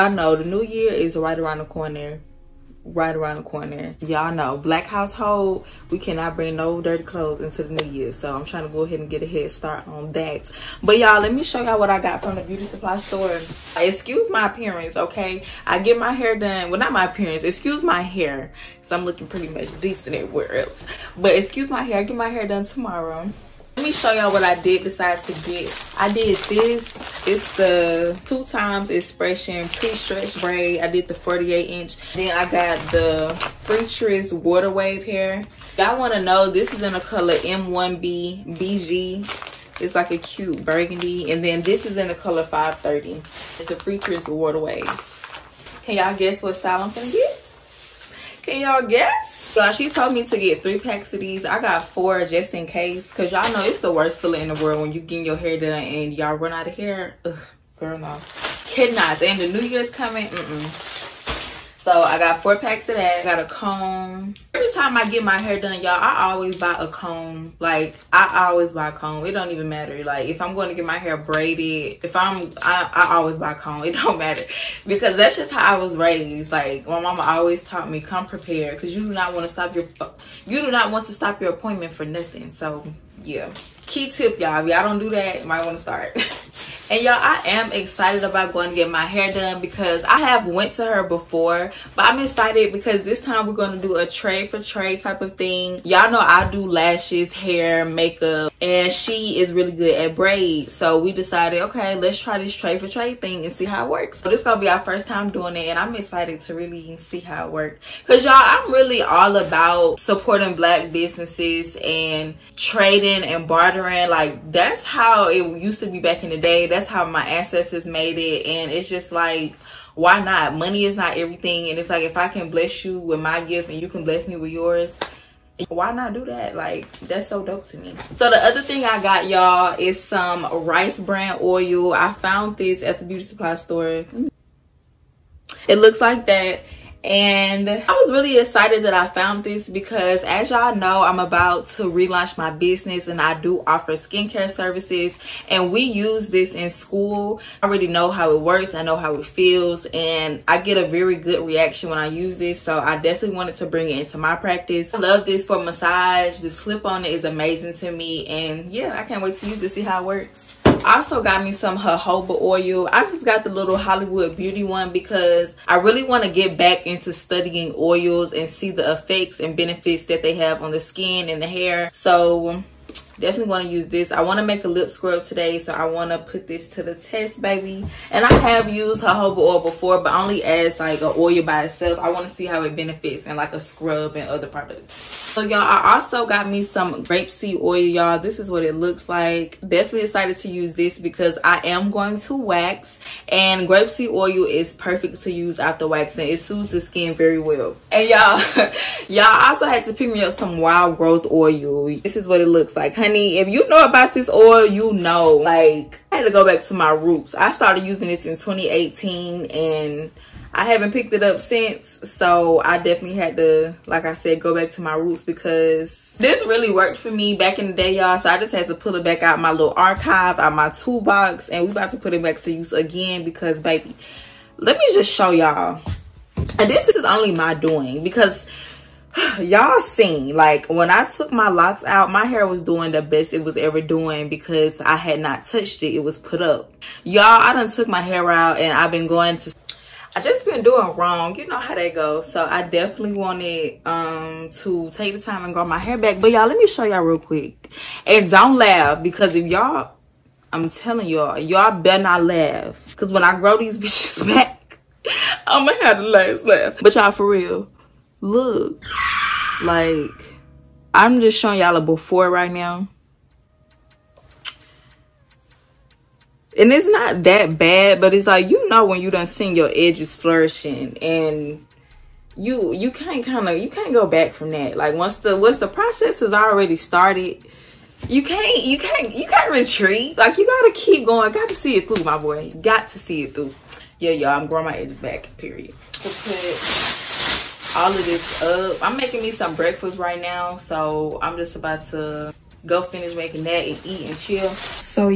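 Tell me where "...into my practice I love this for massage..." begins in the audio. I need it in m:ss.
2:33.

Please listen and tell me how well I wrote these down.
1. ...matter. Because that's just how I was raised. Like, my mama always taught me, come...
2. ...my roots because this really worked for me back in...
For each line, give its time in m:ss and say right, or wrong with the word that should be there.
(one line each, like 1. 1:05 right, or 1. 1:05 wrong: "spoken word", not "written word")
1. 1:14 right
2. 3:34 right.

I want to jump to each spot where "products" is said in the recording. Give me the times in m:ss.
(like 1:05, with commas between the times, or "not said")
3:04.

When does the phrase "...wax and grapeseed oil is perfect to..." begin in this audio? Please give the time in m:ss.
3:12.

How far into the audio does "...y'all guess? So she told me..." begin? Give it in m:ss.
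0:48.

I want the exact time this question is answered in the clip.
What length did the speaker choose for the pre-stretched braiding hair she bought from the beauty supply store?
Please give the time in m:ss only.
0:31.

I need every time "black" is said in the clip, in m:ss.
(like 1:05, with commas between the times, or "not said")
0:04, 1:50.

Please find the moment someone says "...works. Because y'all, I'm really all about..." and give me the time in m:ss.
1:47.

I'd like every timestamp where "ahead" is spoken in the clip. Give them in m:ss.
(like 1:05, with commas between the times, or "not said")
0:08.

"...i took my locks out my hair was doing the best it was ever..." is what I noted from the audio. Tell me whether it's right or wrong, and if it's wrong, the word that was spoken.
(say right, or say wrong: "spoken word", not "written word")
right.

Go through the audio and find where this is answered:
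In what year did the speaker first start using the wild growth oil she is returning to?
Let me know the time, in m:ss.
3:28.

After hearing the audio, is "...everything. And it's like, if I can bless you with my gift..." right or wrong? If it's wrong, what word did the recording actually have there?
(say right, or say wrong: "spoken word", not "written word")
right.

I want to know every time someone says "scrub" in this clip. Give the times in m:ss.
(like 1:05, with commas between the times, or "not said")
2:54, 3:03.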